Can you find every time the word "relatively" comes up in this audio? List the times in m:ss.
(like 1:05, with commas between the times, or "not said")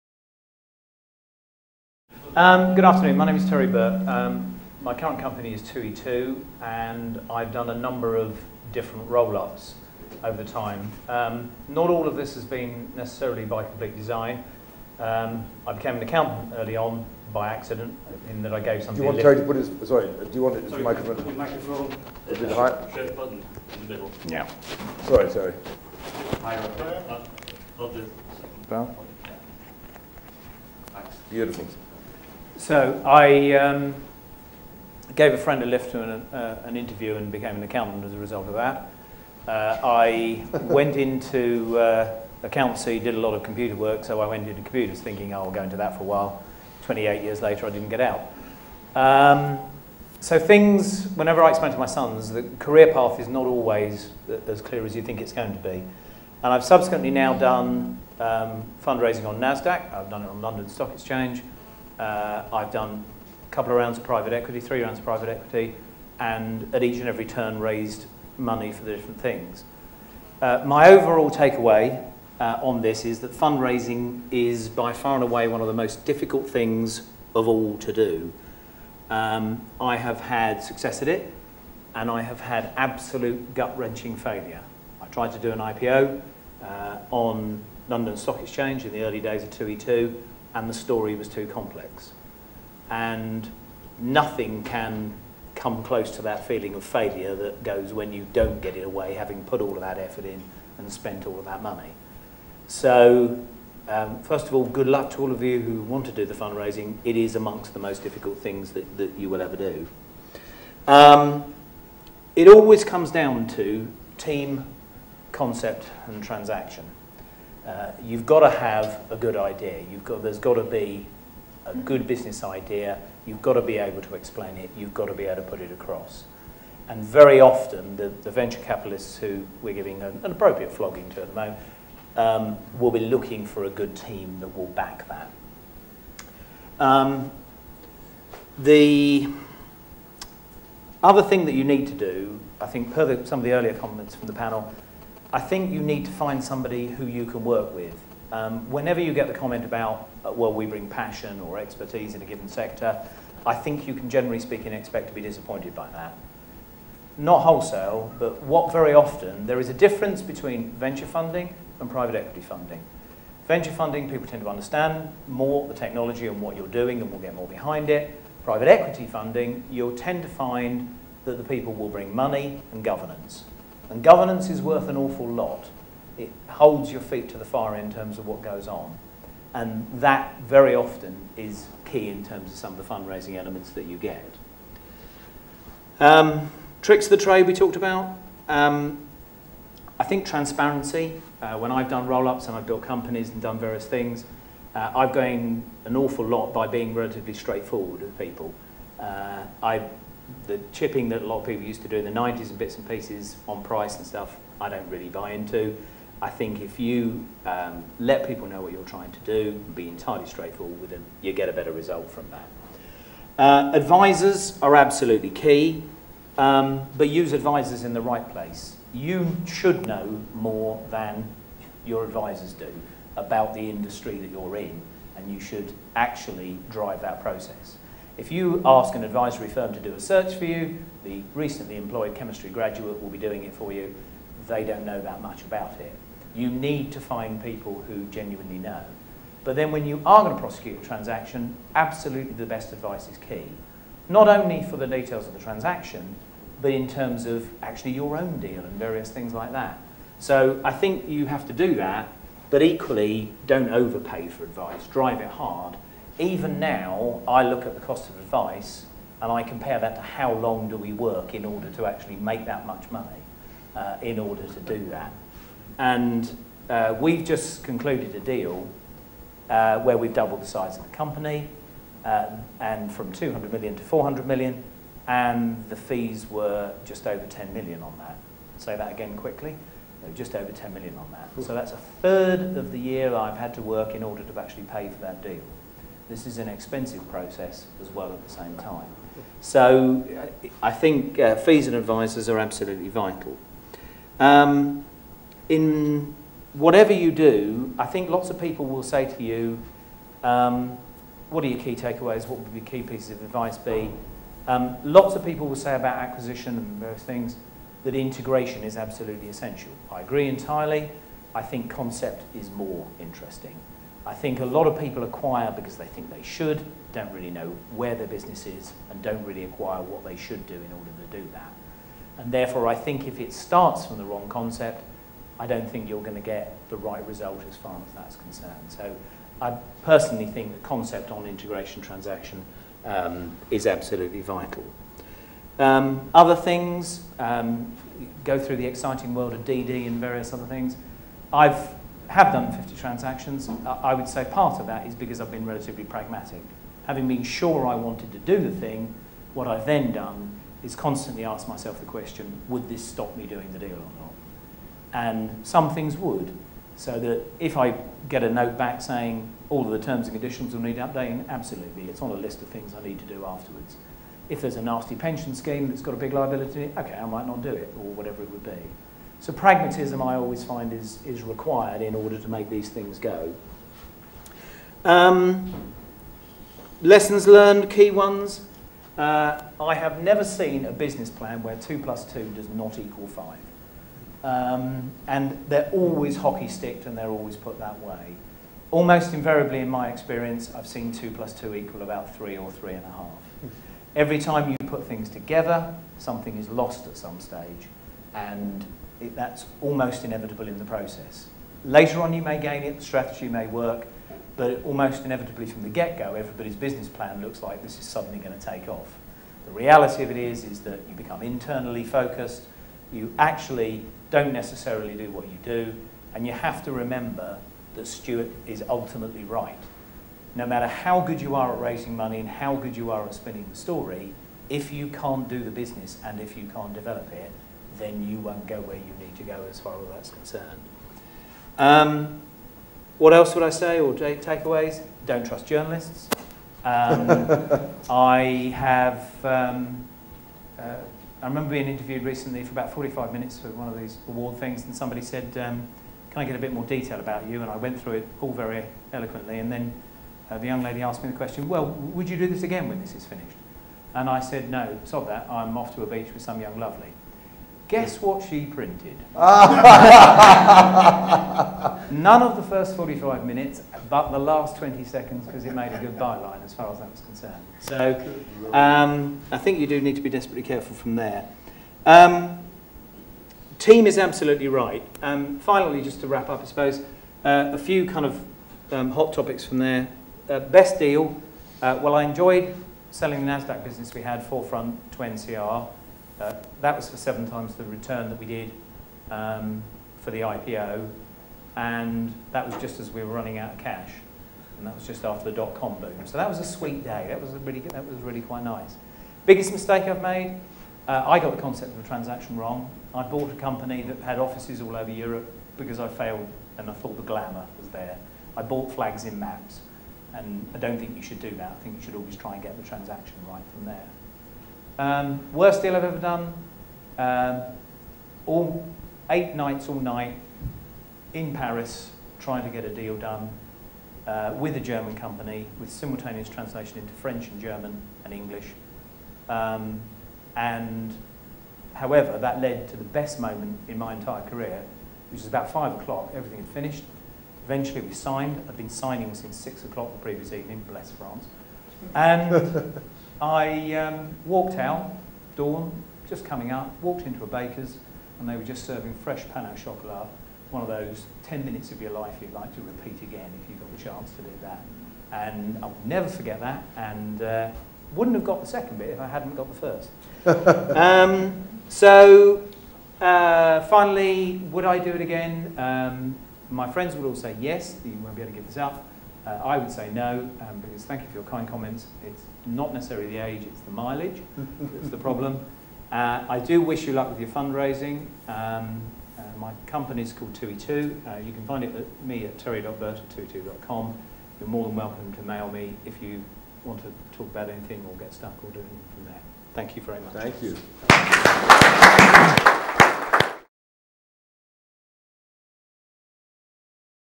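3:16, 5:45.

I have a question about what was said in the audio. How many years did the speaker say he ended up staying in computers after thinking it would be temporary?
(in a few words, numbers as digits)
28.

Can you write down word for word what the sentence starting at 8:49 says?
Um, and however, that led to the best moment in my entire career, which was about five o'clock, everything had finished.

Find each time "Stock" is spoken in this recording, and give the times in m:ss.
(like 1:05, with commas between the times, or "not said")
1:00, 1:28.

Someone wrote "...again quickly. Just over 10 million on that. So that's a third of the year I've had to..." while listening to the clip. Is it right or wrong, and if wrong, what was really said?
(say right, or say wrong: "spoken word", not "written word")
right.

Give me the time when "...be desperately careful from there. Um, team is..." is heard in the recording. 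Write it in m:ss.
7:50.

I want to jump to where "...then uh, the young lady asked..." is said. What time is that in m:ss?
7:29.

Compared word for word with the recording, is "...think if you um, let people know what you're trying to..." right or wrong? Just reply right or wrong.
right.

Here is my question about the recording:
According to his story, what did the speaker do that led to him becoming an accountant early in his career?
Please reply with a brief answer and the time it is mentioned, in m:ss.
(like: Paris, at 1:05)
Gave a friend a lift, at 0:35.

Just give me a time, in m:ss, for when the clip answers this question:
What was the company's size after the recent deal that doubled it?
4:33.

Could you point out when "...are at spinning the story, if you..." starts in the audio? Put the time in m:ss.
7:02.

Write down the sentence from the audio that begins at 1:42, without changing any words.
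So, um, first of all, good luck to all of you who want to do the fundraising.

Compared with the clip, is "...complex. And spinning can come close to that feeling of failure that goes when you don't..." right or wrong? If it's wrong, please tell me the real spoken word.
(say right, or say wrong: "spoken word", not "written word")
wrong: "nothing", not "spinning".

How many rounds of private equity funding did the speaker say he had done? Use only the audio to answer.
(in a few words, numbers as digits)
Three.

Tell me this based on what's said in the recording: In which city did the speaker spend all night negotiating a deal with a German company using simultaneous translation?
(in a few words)
Paris.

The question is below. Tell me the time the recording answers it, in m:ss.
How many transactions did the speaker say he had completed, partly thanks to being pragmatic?
5:42.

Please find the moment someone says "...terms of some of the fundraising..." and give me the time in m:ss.
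3:02.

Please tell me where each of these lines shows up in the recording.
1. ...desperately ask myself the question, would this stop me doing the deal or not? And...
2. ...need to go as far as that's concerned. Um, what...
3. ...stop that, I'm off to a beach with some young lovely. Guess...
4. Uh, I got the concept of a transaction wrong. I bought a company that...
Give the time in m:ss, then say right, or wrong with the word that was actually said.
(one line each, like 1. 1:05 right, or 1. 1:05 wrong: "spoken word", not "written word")
1. 5:50 wrong: "constantly", not "desperately"
2. 7:08 right
3. 7:34 right
4. 8:20 right.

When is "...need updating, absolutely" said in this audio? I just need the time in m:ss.
6:00.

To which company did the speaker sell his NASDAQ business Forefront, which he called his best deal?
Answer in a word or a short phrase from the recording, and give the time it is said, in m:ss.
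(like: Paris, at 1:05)
NCR, at 8:04.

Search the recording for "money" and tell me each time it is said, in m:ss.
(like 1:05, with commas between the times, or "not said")
1:08, 1:41, 2:52, 4:22, 7:01.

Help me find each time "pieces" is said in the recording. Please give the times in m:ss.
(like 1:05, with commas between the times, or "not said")
3:22, 5:02.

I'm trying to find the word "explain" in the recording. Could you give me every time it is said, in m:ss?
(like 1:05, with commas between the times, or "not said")
0:51, 2:04.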